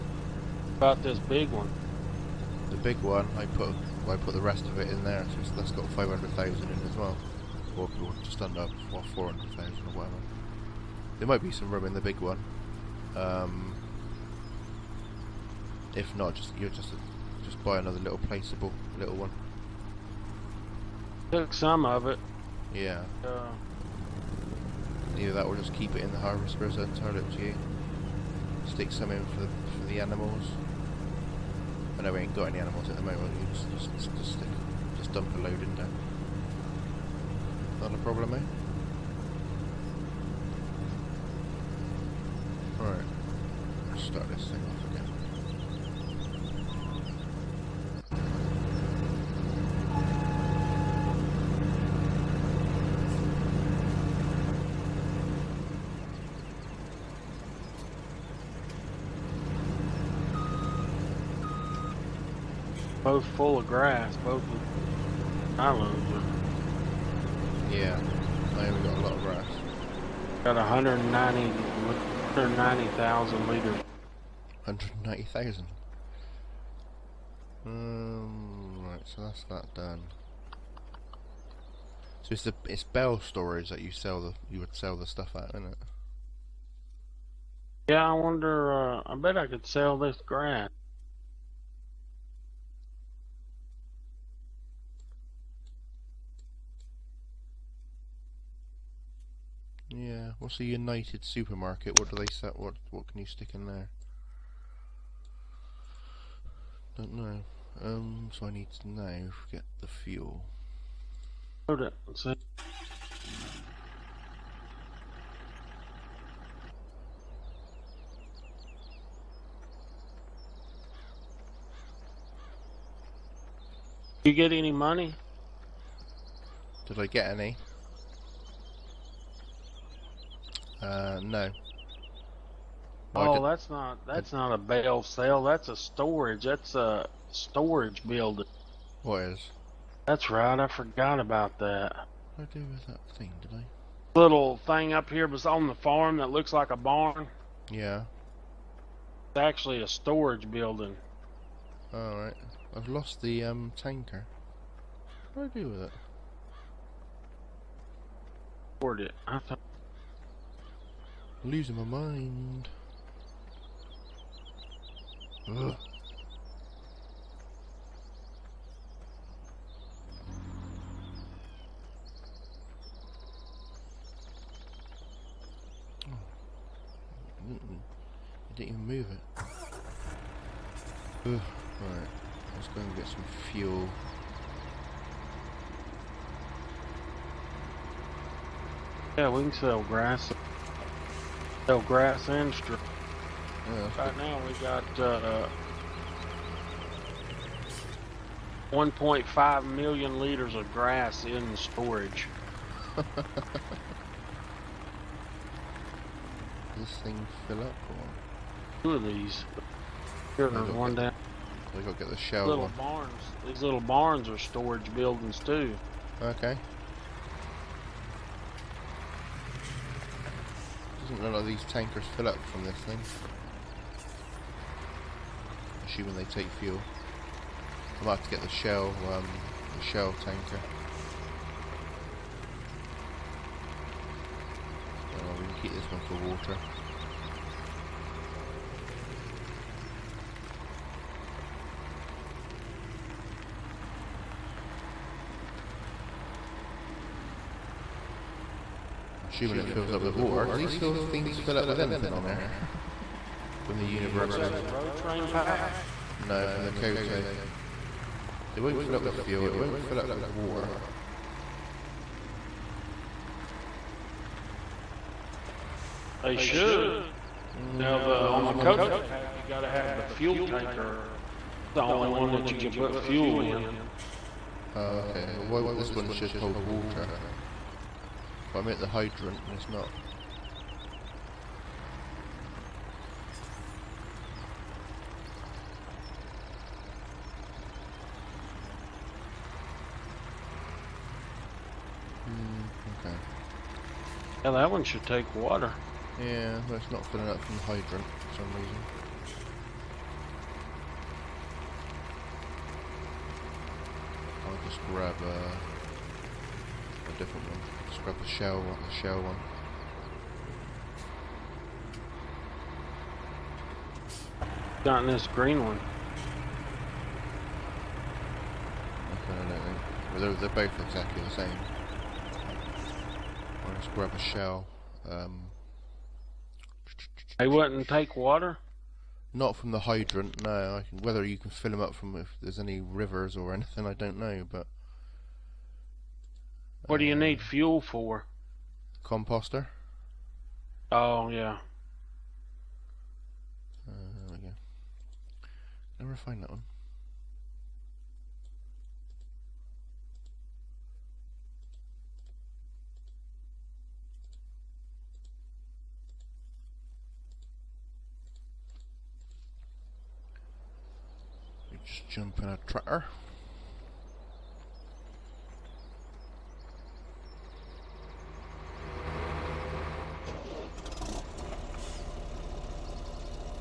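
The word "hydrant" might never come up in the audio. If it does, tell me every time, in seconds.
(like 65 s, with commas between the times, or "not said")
278 s, 297 s, 329 s.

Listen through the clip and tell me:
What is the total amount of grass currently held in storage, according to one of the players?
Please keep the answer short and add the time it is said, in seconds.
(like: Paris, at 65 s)
1.5 million liters, at 198 s.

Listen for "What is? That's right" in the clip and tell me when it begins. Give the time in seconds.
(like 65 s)
139 s.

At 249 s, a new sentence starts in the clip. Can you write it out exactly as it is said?
assuming it fills up with water, because these sort of things fill up with anything on there.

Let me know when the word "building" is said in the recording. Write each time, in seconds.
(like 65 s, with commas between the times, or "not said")
138 s, 150 s, 214 s.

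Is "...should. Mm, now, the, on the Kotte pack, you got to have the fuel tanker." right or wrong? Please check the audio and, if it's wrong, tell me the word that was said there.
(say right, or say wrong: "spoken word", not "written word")
right.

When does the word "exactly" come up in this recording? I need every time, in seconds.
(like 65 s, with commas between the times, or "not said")
320 s.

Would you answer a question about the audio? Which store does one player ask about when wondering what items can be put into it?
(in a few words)
United supermarket.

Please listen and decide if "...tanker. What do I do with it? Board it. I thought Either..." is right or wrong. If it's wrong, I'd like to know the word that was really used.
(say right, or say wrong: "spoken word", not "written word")
wrong: "Losing", not "Either".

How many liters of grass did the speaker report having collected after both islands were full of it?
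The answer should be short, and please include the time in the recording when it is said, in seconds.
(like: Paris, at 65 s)
190,000 liters, at 71 s.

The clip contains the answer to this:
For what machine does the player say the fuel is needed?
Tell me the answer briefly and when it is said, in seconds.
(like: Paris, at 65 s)
Composter, at 339 s.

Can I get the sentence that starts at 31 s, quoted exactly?
I know we ain't got any animals at the moment, you just, just, just, stick, just dump a load in there.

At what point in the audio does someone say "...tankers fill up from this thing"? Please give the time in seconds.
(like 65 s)
221 s.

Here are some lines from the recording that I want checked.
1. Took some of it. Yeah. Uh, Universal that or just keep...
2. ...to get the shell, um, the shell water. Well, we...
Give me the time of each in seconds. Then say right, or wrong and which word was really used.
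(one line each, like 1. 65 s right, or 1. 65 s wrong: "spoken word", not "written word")
1. 21 s wrong: "Either", not "Universal"
2. 228 s wrong: "tanker", not "water".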